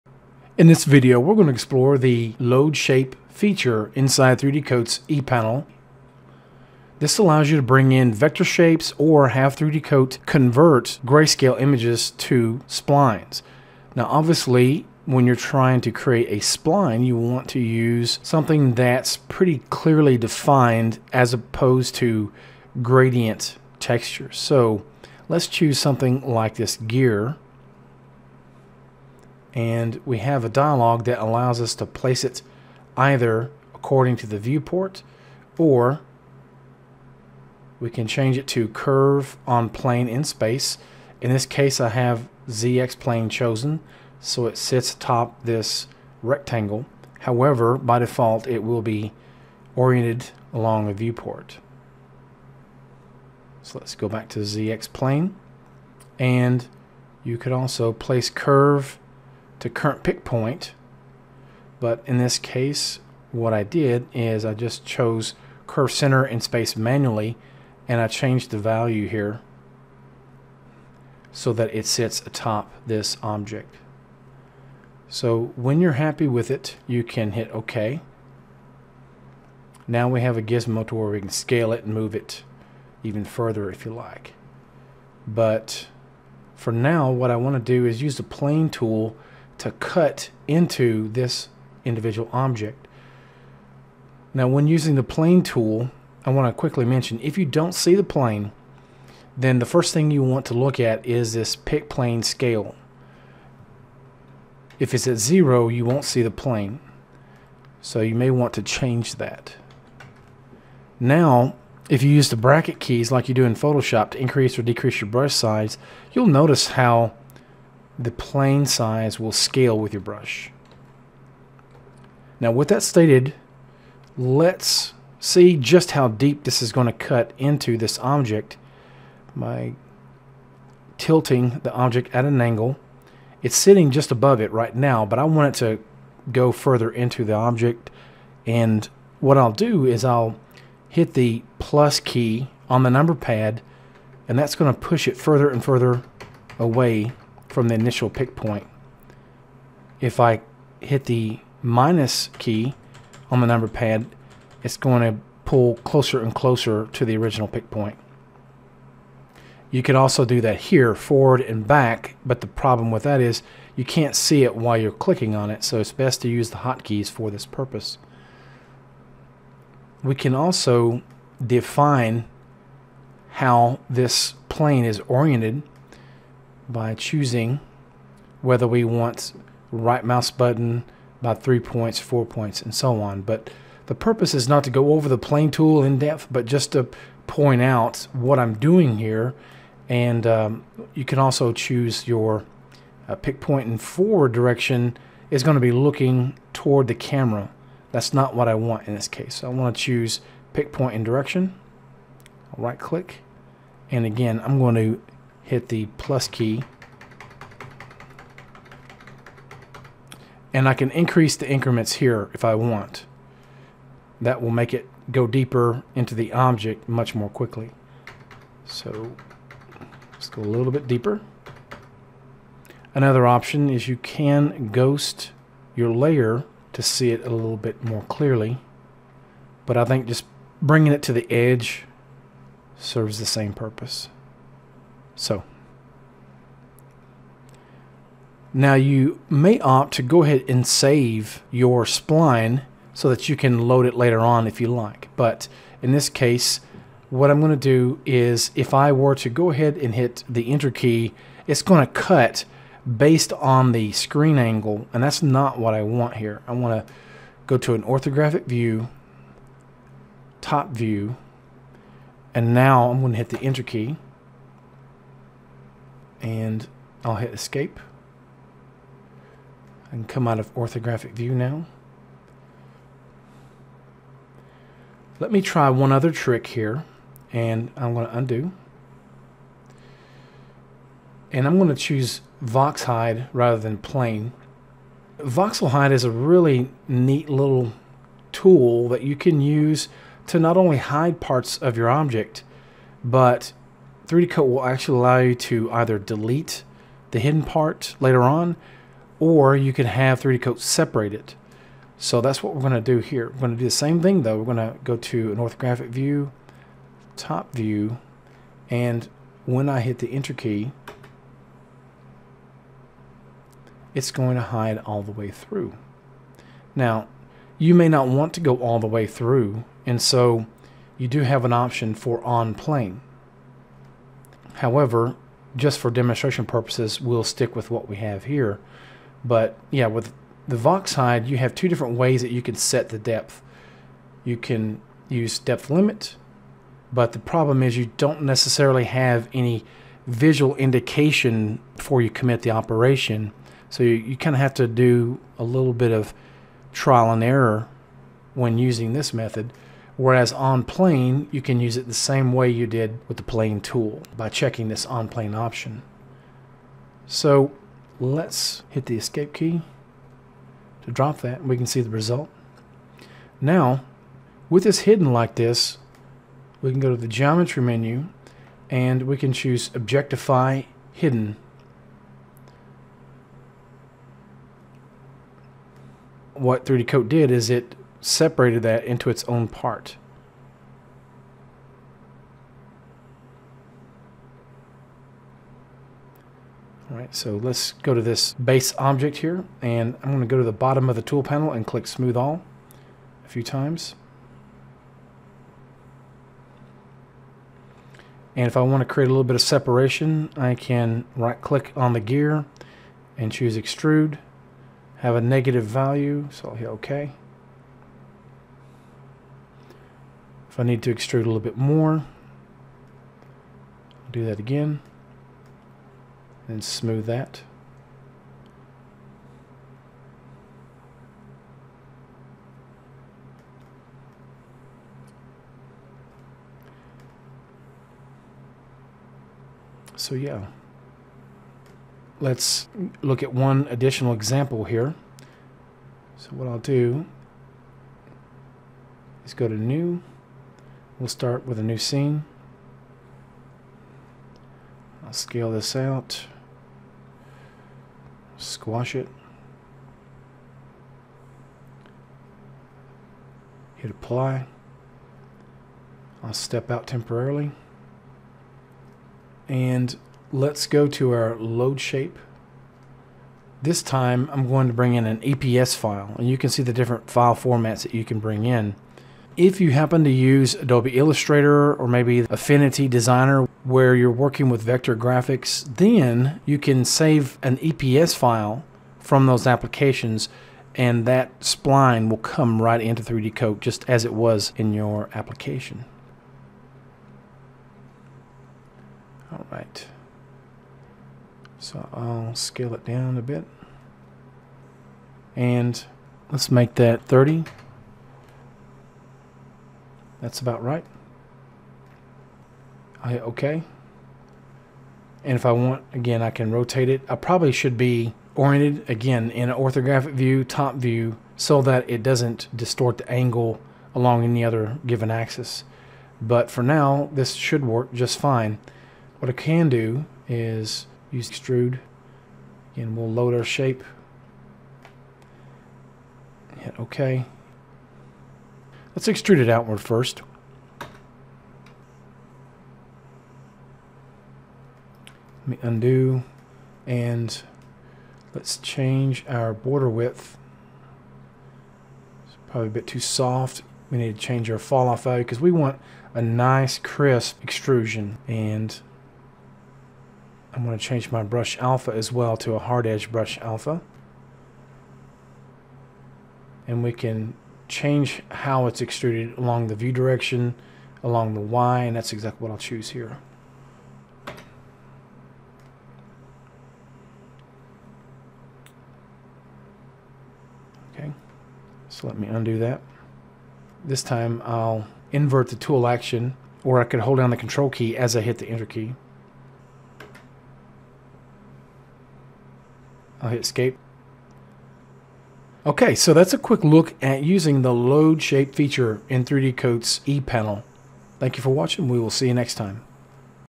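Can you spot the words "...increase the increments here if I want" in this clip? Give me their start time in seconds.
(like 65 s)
210 s.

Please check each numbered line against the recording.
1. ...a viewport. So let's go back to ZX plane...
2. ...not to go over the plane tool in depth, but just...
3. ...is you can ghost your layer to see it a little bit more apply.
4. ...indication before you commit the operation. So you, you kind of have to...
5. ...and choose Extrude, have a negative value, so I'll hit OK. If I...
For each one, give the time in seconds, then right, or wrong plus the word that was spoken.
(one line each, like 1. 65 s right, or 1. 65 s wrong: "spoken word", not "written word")
1. 50 s right
2. 184 s right
3. 223 s wrong: "clearly", not "apply"
4. 340 s right
5. 403 s right.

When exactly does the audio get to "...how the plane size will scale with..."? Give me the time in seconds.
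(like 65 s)
116 s.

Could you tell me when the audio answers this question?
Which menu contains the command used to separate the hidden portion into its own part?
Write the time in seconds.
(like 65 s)
367 s.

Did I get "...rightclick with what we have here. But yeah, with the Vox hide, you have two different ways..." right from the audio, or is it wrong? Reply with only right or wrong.
wrong.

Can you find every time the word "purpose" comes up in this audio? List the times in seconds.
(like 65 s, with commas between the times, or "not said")
167 s, 183 s, 233 s, 326 s.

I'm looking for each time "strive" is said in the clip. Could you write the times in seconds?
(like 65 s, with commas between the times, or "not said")
not said.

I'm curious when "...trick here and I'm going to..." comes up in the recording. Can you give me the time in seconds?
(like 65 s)
276 s.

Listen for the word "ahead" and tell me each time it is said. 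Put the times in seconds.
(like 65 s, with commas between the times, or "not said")
240 s, 249 s.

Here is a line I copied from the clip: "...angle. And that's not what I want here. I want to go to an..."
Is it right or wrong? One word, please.
right.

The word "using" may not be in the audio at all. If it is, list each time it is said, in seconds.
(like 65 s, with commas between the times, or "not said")
94 s, 348 s, 587 s.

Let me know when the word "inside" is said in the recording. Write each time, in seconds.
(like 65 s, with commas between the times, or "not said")
3 s.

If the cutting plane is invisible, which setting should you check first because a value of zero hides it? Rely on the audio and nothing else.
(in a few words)
pick plane scale.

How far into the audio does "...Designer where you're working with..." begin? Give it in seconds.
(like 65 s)
472 s.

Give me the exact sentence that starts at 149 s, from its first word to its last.
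If I hit the minus key on the number pad, it's going to pull closer and closer to the original pick point.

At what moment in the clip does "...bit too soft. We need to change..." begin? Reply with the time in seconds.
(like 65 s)
542 s.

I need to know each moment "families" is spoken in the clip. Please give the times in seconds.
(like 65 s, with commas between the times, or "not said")
not said.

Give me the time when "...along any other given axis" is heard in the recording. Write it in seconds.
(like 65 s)
513 s.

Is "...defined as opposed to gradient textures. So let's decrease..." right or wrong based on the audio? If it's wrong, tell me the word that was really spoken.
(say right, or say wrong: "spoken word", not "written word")
wrong: "choose", not "decrease".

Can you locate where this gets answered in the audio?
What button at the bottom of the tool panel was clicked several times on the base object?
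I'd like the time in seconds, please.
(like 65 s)
391 s.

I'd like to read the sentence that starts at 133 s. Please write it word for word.
It's sitting just above it right now, but I want it to go further into the object.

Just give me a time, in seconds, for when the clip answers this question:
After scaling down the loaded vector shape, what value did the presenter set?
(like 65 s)
497 s.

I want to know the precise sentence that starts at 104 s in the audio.
If it's at zero, you won't see the plane.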